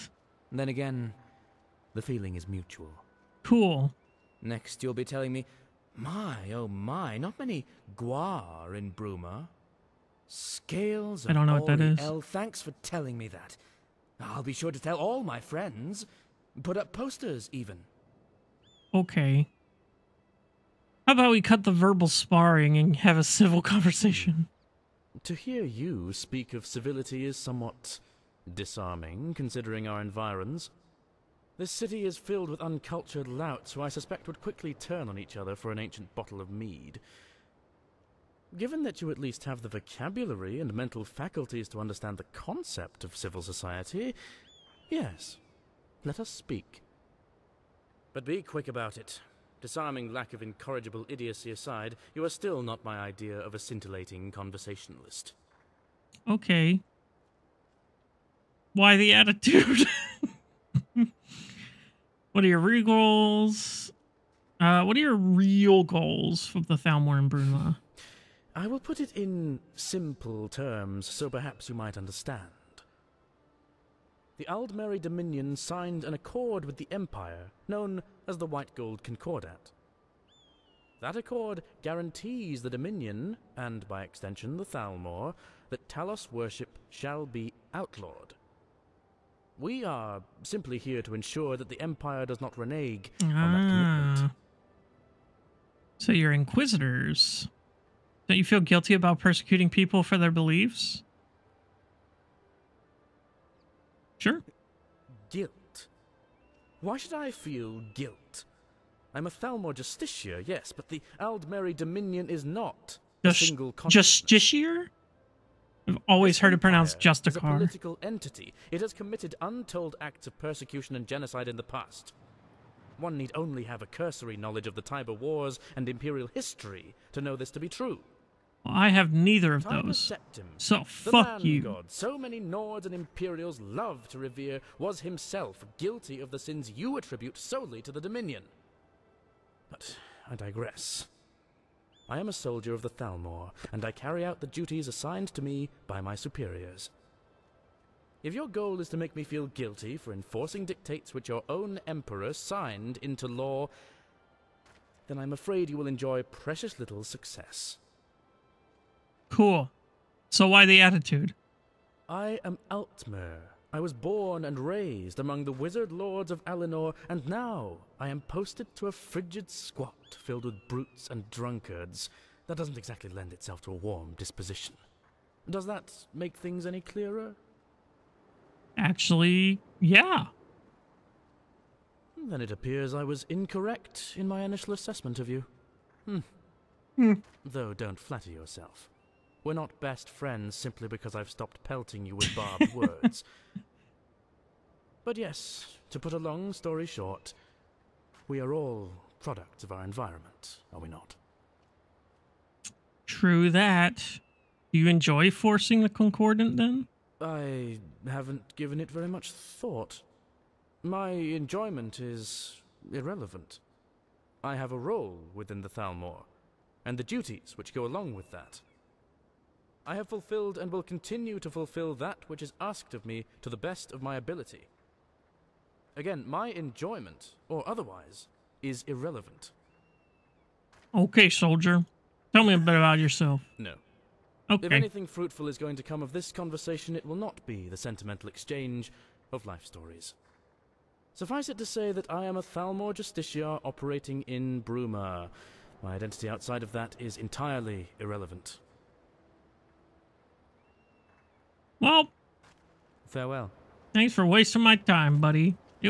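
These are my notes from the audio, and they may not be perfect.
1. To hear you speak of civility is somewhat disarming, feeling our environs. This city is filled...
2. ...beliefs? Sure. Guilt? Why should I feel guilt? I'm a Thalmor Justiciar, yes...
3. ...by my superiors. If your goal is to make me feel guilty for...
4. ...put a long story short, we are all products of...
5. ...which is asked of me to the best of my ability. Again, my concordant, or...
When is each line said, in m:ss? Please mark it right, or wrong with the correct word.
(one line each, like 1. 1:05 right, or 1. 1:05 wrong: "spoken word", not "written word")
1. 0:25 wrong: "considering", not "feeling"
2. 1:40 right
3. 2:25 right
4. 3:15 right
5. 3:42 wrong: "enjoyment", not "concordant".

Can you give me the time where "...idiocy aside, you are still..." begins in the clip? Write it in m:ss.
0:51.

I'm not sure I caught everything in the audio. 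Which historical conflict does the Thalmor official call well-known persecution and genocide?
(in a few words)
Tiber Wars.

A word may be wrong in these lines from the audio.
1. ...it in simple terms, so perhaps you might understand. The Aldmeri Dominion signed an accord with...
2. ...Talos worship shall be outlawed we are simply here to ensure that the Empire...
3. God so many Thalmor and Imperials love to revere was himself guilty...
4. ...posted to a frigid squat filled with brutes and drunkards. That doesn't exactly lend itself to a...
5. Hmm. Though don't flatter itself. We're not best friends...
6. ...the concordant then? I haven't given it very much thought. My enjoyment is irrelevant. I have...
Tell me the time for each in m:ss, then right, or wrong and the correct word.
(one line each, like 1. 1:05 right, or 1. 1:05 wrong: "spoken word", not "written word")
1. 1:09 right
2. 1:25 right
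3. 2:11 wrong: "Nords", not "Thalmor"
4. 2:48 right
5. 3:06 wrong: "yourself", not "itself"
6. 3:25 right.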